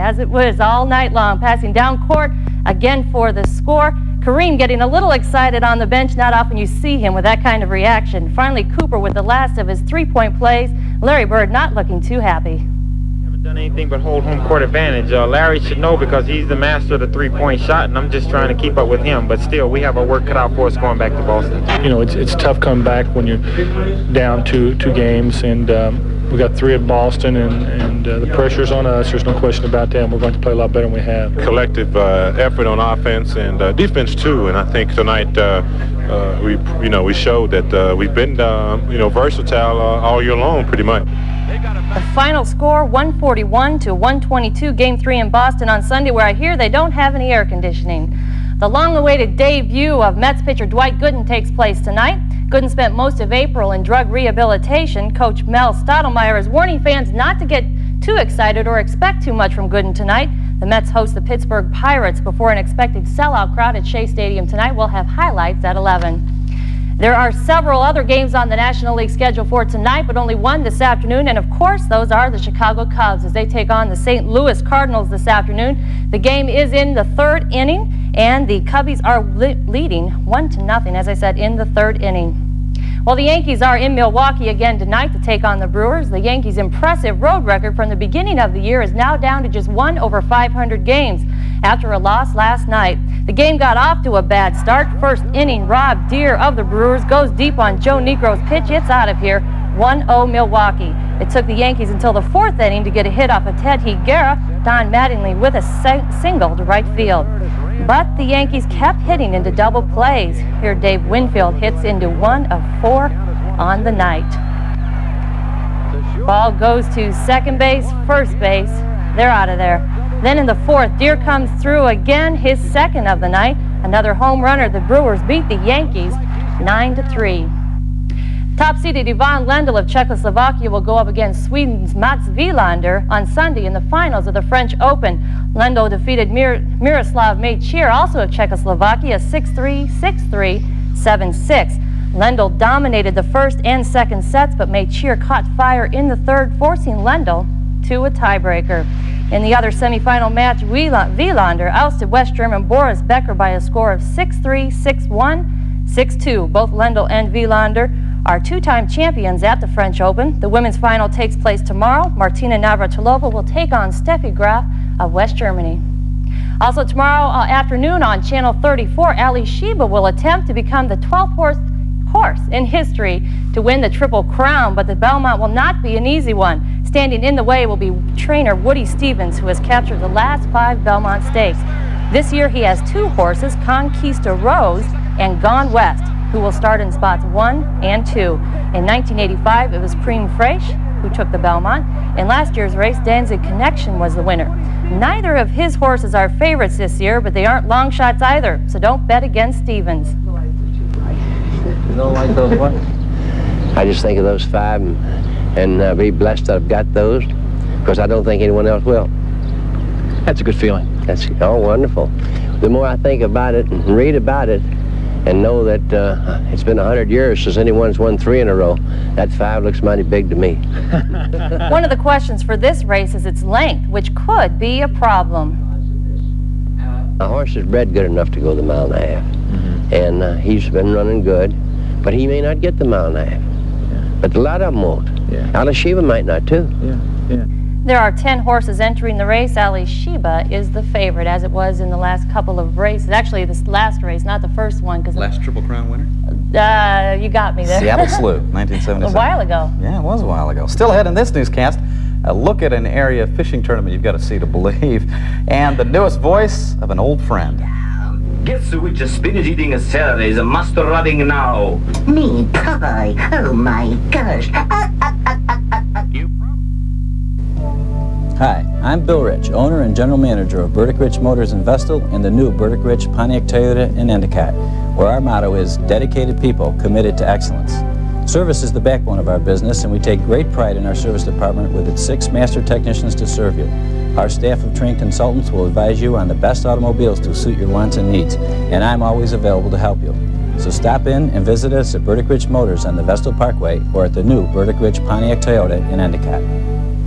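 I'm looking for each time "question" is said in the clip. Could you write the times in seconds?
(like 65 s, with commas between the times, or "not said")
29 s, 222 s.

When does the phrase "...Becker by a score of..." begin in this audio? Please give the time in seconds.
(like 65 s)
153 s.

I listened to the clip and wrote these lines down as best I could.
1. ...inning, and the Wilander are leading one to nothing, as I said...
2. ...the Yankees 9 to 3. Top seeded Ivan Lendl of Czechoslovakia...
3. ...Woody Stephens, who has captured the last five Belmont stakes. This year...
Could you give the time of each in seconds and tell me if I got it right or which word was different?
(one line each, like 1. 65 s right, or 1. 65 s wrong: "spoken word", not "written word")
1. 77 s wrong: "Cubbies", not "Wilander"
2. 125 s right
3. 178 s right.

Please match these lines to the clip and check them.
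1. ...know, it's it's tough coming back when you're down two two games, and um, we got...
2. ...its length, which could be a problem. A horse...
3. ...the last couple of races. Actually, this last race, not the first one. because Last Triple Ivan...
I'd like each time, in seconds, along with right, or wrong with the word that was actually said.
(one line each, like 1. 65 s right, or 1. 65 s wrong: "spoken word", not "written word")
1. 21 s right
2. 223 s right
3. 241 s wrong: "Crown", not "Ivan".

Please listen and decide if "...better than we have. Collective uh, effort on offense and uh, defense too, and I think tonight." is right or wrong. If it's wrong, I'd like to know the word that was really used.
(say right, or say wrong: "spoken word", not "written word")
right.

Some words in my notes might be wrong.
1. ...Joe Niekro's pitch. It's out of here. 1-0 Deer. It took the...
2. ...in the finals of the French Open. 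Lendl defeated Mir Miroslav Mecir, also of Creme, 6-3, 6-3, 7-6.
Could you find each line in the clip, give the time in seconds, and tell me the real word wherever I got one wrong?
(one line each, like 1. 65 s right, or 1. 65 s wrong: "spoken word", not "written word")
1. 97 s wrong: "Milwaukee", not "Deer"
2. 133 s wrong: "Czechoslovakia", not "Creme".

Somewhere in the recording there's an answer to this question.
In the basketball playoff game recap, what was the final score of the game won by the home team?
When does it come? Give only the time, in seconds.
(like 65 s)
42 s.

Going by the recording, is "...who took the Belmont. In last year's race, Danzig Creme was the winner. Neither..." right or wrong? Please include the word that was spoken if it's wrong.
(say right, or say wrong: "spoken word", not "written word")
wrong: "Connection", not "Creme".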